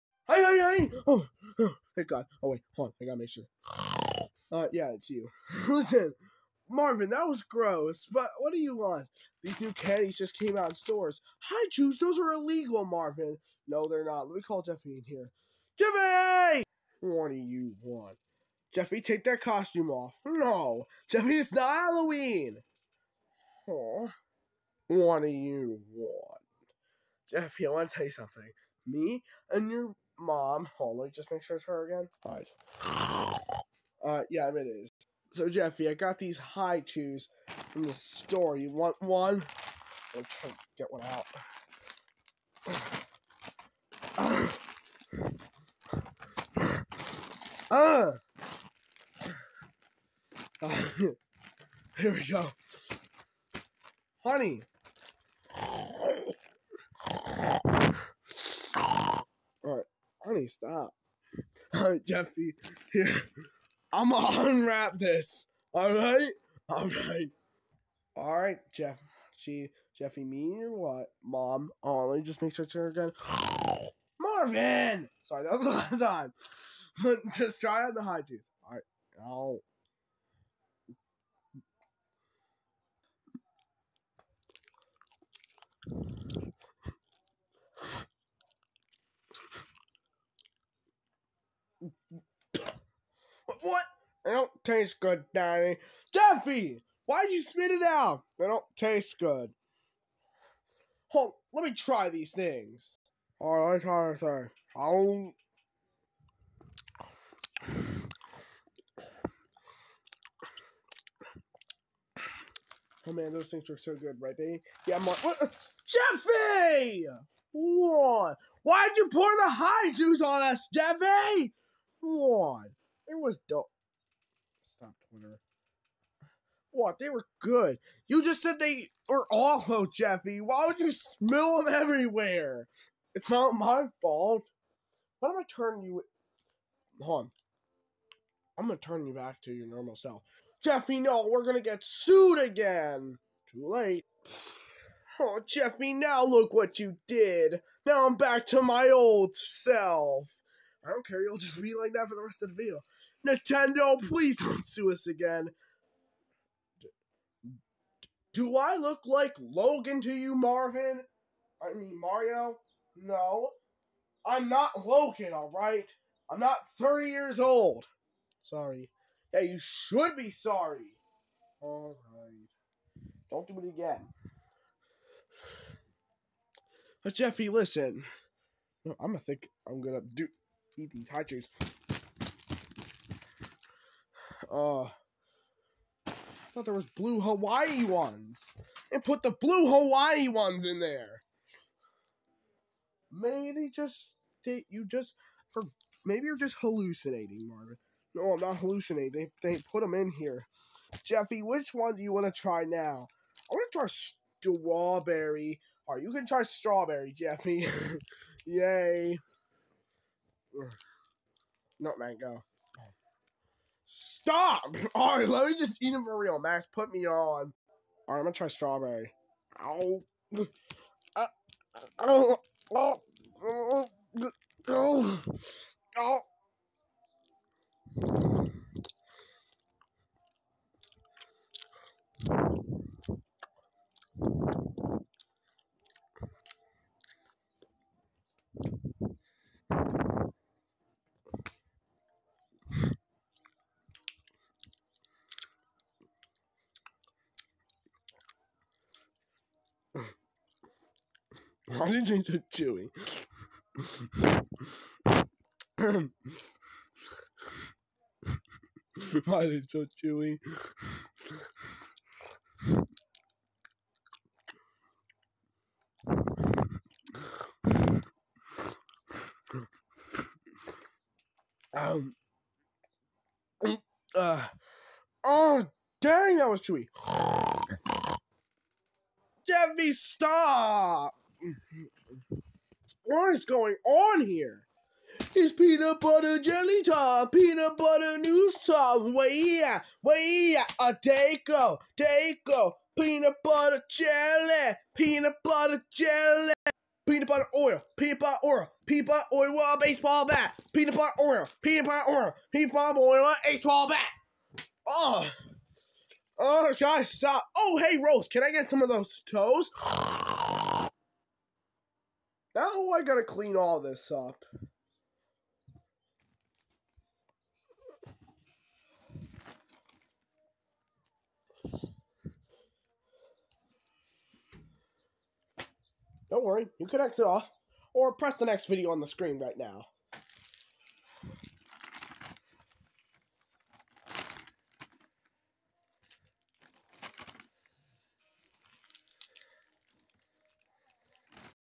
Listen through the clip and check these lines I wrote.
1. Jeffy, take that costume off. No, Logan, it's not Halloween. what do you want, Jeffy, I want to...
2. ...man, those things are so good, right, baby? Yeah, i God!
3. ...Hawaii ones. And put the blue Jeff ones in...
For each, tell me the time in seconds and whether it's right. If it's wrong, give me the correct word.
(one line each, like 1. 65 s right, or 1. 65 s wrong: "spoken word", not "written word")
1. 18 s wrong: "Jeffy", not "Logan"
2. 113 s wrong: "Jeffy", not "God"
3. 187 s wrong: "Hawaii", not "Jeff".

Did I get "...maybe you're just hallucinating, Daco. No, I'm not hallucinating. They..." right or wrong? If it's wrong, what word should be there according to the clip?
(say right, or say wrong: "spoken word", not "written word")
wrong: "Marvin", not "Daco".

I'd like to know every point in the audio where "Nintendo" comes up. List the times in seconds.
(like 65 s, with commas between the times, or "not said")
153 s.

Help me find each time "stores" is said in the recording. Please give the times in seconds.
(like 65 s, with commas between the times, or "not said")
10 s, 37 s.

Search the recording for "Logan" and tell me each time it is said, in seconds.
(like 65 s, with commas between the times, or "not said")
159 s, 164 s.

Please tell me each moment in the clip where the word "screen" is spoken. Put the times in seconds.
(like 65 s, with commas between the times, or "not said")
329 s.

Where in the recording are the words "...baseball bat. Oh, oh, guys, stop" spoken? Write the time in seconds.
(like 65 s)
303 s.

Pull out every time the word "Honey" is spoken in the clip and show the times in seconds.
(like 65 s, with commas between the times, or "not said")
54 s.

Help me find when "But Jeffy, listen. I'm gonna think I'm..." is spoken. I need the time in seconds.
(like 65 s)
177 s.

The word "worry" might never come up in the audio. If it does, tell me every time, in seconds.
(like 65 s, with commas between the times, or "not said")
326 s.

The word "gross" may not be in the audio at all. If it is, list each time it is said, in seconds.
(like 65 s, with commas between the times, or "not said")
7 s.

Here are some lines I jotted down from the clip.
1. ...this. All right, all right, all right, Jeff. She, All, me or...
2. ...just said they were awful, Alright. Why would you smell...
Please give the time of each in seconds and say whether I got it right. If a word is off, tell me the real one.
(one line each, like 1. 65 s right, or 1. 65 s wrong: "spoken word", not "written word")
1. 64 s wrong: "Jeffy", not "All"
2. 128 s wrong: "Jeffy", not "Alright".